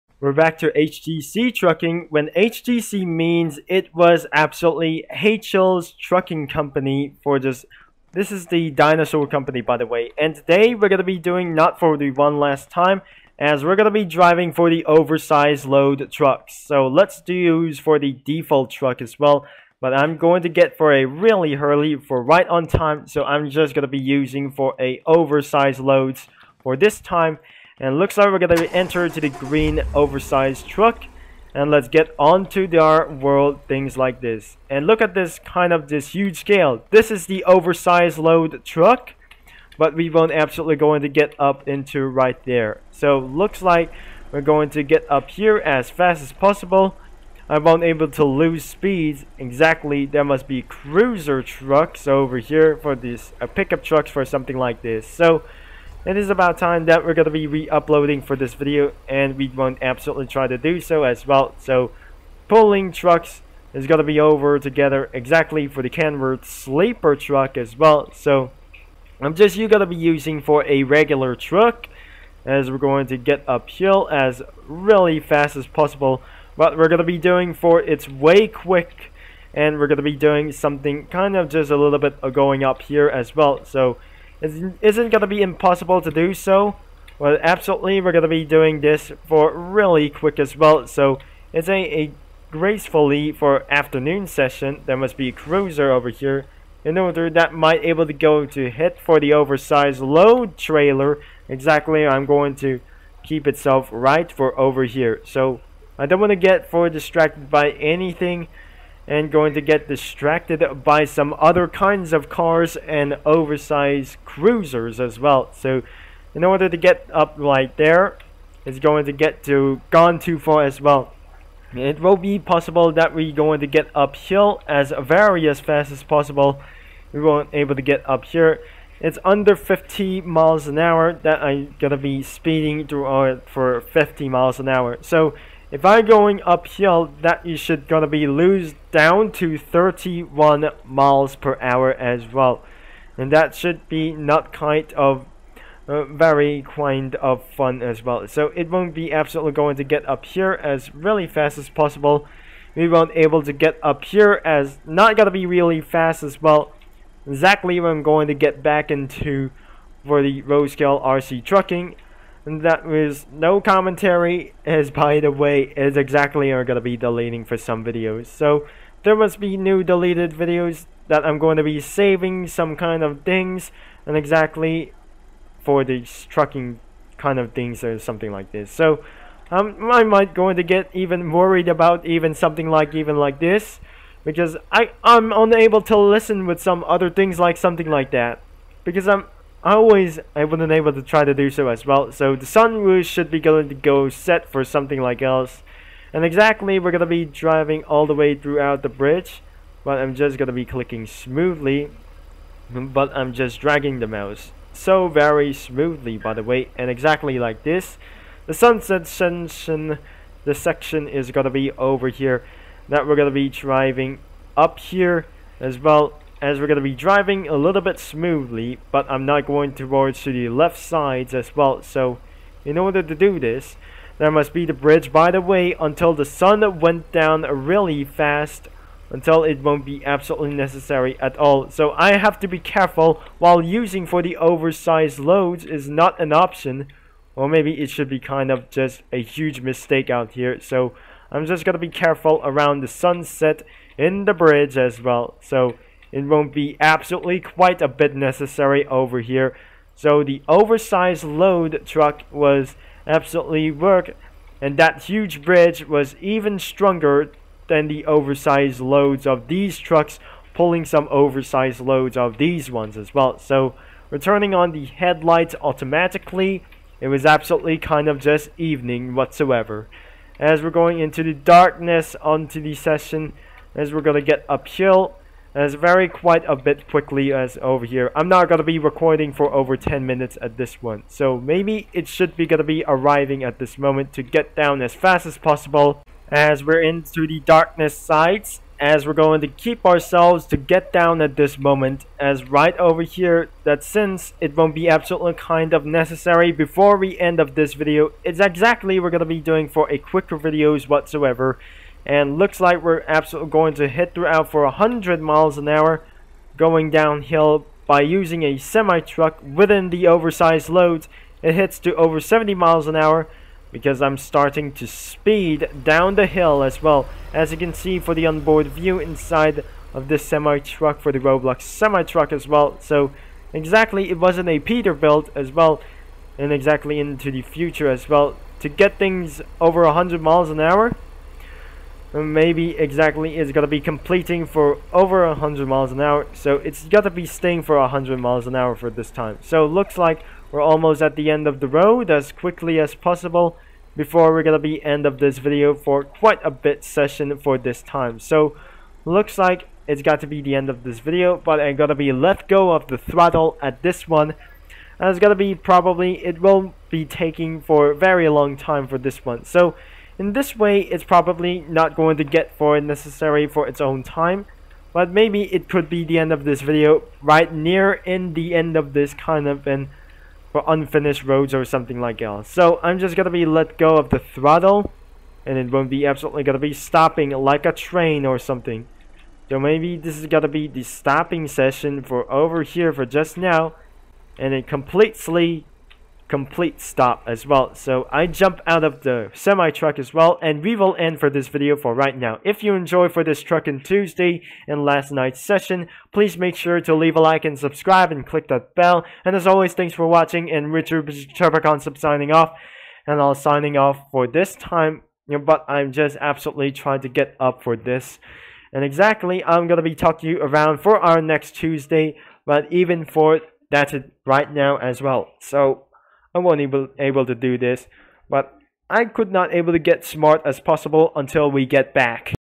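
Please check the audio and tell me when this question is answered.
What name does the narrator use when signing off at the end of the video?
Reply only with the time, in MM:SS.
06:40.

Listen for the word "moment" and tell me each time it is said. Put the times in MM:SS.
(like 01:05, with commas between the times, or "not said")
04:43, 04:51.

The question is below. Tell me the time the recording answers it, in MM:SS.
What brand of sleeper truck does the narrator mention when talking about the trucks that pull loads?
01:05.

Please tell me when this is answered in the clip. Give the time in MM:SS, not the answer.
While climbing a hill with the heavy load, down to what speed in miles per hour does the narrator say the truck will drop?
02:19.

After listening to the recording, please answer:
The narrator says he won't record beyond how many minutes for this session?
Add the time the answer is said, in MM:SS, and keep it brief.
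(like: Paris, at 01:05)
10, at 04:39.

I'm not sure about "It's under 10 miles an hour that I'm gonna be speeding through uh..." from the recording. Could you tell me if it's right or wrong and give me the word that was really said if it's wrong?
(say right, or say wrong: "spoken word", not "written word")
wrong: "50", not "10".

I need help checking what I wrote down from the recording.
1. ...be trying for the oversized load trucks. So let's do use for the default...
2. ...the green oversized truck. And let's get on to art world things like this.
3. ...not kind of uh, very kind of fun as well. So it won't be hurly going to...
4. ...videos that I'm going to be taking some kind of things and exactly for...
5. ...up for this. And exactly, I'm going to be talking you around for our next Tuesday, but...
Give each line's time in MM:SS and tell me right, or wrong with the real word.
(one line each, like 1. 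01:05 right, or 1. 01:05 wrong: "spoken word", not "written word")
1. 00:13 wrong: "driving", not "trying"
2. 00:29 right
3. 02:24 wrong: "absolutely", not "hurly"
4. 02:50 wrong: "saving", not "taking"
5. 06:47 right.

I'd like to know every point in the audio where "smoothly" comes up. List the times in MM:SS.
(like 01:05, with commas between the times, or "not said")
03:21, 03:25, 03:37.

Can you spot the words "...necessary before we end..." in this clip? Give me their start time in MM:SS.
04:55.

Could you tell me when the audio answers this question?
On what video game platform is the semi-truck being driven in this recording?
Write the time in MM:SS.
05:21.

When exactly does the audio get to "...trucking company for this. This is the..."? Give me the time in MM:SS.
00:05.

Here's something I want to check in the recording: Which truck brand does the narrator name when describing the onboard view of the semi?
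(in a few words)
Peterbilt.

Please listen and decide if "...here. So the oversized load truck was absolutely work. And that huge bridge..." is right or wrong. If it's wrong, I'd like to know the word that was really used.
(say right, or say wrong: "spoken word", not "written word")
right.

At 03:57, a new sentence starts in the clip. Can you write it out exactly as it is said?
Or maybe it should be kind of just a huge mistake out here.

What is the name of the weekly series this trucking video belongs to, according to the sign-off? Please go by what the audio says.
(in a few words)
Trucking Tuesday.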